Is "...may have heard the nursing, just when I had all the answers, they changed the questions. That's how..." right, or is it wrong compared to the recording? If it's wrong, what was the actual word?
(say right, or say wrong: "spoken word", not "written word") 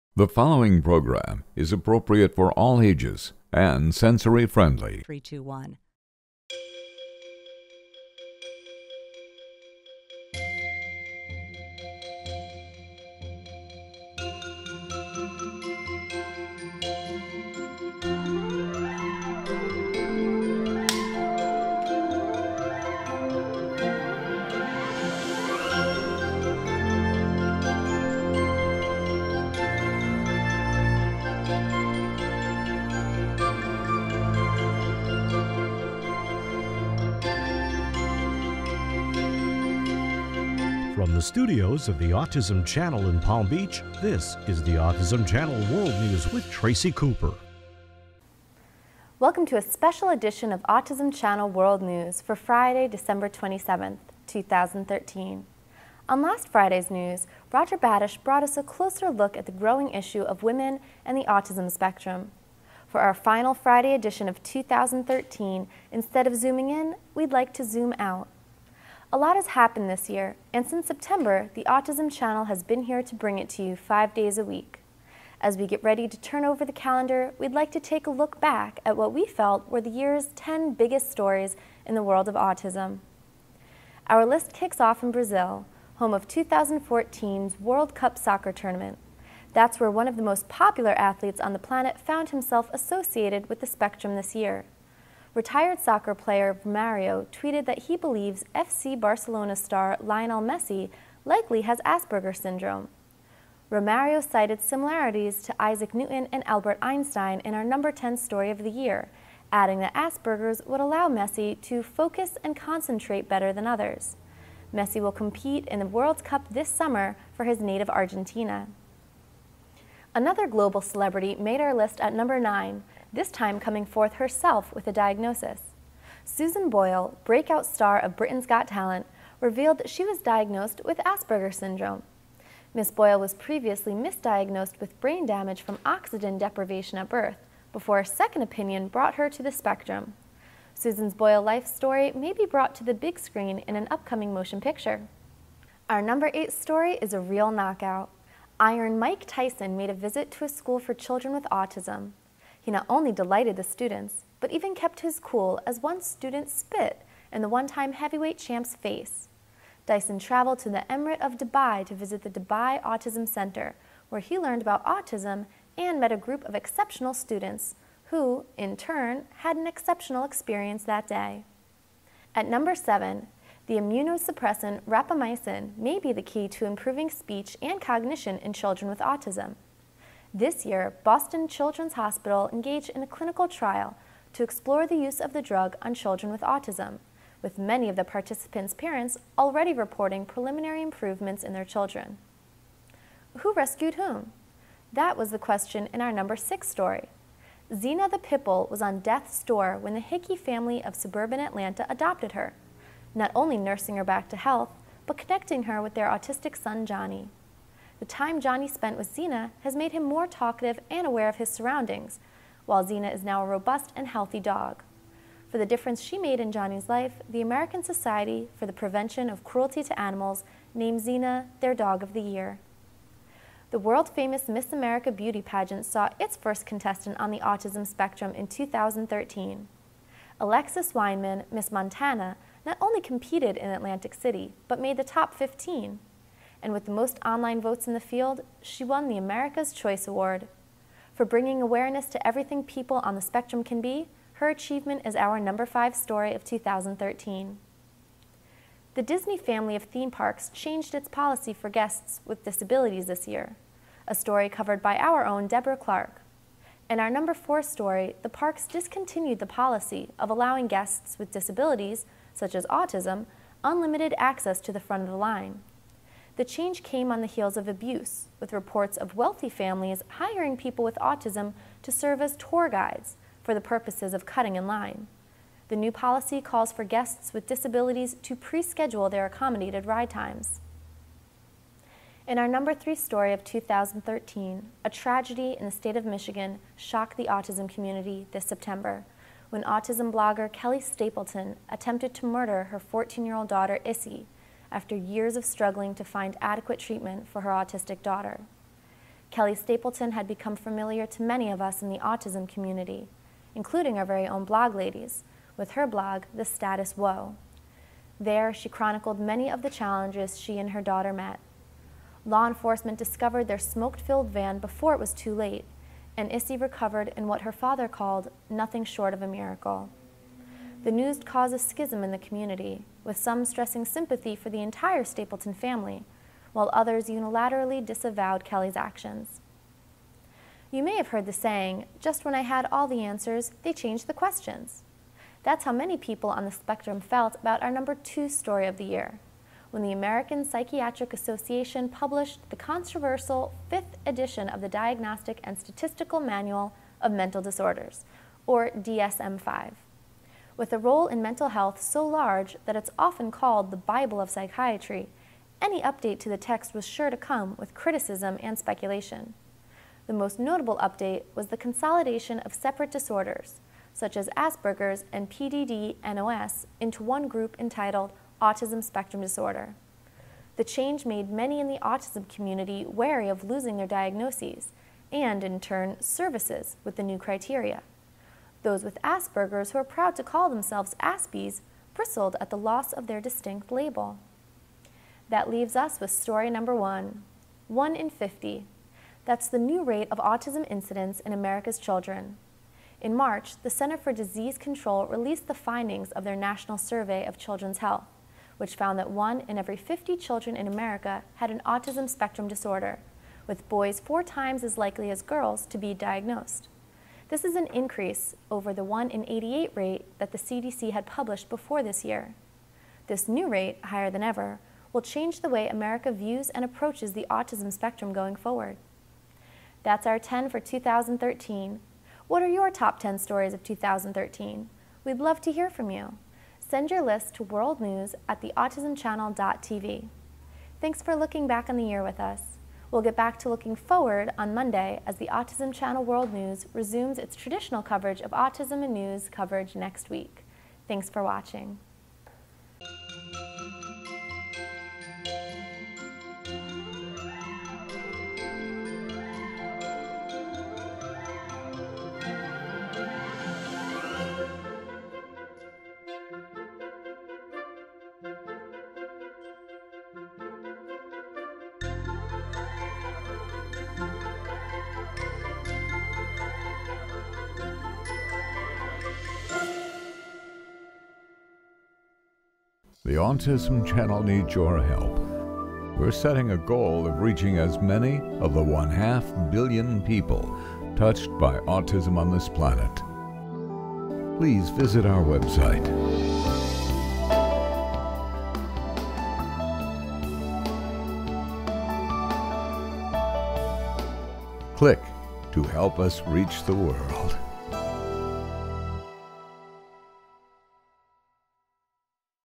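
wrong: "saying", not "nursing".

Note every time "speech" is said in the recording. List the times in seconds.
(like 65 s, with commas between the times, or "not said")
177 s.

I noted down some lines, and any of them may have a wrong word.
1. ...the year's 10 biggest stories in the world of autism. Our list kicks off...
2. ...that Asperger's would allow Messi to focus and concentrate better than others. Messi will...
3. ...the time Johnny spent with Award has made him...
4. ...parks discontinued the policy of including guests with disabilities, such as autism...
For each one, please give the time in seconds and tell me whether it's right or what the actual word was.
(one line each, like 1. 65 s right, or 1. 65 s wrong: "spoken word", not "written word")
1. 79 s right
2. 109 s right
3. 208 s wrong: "Xena", not "Award"
4. 258 s wrong: "allowing", not "including".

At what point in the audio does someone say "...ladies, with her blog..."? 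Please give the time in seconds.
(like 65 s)
304 s.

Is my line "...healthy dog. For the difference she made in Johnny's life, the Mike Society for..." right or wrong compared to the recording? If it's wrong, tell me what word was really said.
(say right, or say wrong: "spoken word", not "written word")
wrong: "American", not "Mike".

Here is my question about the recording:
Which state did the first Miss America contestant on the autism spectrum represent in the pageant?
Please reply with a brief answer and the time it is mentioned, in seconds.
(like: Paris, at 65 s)
Montana, at 231 s.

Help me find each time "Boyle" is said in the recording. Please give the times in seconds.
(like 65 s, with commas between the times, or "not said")
126 s, 132 s, 141 s.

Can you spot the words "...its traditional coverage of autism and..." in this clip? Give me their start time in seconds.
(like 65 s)
437 s.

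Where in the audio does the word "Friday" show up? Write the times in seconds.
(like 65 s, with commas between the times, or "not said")
52 s, 56 s, 63 s.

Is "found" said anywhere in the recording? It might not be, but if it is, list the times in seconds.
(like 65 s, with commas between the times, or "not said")
91 s, 398 s.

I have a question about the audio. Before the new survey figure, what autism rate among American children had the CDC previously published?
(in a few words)
1 in 88.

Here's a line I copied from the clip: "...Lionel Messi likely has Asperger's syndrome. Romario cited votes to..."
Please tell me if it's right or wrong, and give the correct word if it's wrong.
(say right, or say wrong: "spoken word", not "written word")
wrong: "similarities", not "votes".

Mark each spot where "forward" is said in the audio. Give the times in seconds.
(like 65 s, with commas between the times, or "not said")
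418 s, 433 s.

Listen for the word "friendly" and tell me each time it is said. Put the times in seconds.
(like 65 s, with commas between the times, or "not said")
4 s.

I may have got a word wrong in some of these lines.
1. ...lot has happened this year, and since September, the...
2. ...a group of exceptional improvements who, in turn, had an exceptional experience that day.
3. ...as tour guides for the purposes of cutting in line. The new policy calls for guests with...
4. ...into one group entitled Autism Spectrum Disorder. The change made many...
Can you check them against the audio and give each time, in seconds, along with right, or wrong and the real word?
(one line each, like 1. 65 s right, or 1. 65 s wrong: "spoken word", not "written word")
1. 69 s right
2. 166 s wrong: "students", not "improvements"
3. 272 s right
4. 366 s right.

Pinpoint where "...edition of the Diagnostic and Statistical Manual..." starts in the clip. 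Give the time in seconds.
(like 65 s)
344 s.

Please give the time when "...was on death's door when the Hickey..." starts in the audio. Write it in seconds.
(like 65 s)
198 s.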